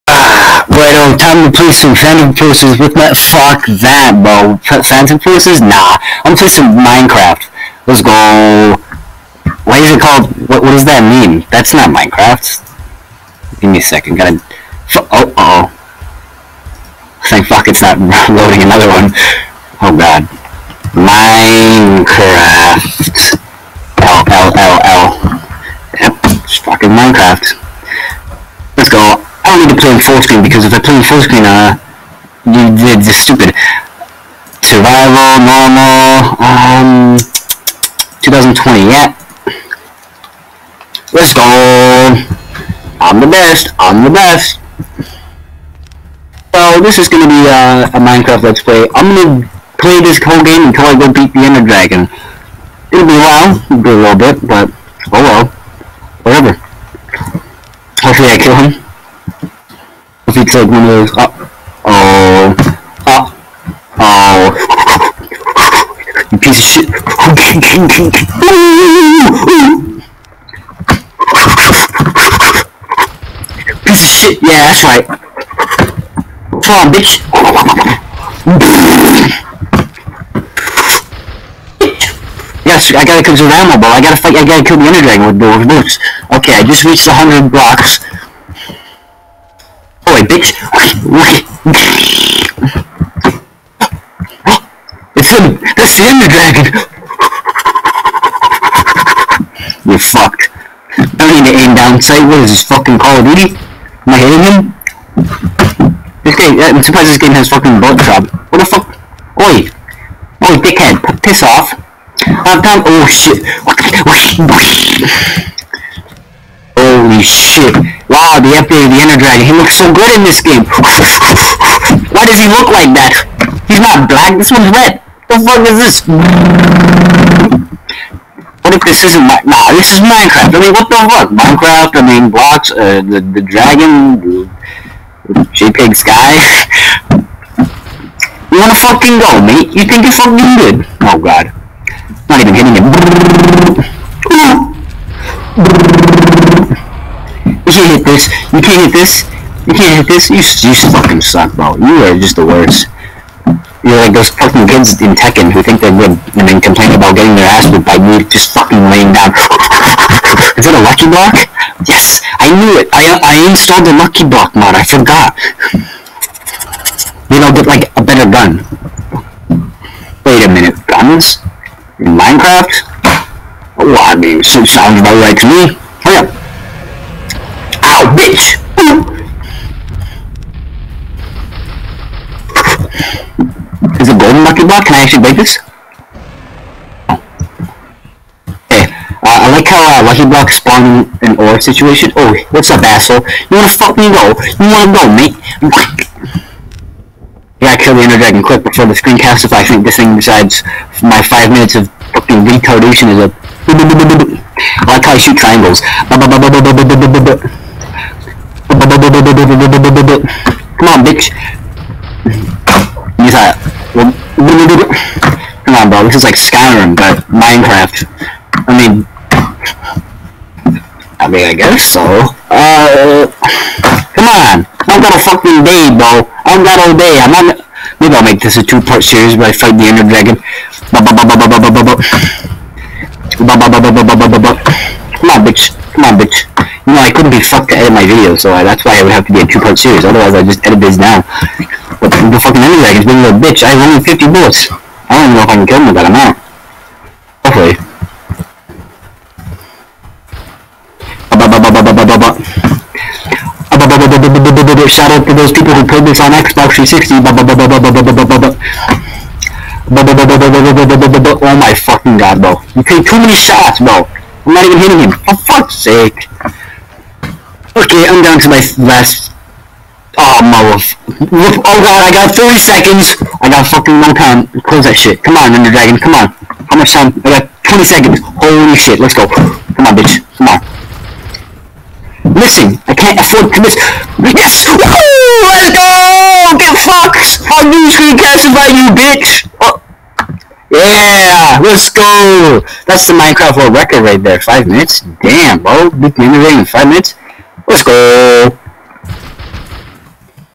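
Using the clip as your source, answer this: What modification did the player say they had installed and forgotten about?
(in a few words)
lucky block mod.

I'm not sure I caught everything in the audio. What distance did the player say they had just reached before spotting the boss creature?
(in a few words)
100 blocks.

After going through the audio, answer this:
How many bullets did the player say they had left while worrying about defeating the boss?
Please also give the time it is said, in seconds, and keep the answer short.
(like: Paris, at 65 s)
50, at 243 s.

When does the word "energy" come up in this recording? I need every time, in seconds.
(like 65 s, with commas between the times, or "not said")
242 s.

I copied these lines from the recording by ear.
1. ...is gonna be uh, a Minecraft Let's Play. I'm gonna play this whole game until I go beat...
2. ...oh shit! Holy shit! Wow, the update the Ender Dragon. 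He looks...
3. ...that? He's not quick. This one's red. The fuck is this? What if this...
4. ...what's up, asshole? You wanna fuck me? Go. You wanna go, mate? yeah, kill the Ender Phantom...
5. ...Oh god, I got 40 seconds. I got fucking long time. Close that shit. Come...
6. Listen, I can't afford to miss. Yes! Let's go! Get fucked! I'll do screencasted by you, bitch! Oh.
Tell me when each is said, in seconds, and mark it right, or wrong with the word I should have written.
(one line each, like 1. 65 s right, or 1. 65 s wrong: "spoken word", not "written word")
1. 46 s right
2. 112 s right
3. 122 s wrong: "black", not "quick"
4. 192 s wrong: "Dragon", not "Phantom"
5. 271 s wrong: "30", not "40"
6. 282 s right.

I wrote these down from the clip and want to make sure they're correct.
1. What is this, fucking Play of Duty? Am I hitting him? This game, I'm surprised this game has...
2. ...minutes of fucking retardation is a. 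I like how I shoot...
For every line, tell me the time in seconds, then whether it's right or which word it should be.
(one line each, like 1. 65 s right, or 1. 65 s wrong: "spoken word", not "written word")
1. 102 s wrong: "Call", not "Play"
2. 201 s right.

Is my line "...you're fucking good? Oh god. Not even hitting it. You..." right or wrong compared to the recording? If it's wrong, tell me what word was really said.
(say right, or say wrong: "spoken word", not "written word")
right.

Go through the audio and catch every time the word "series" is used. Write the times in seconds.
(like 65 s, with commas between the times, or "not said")
229 s, 239 s.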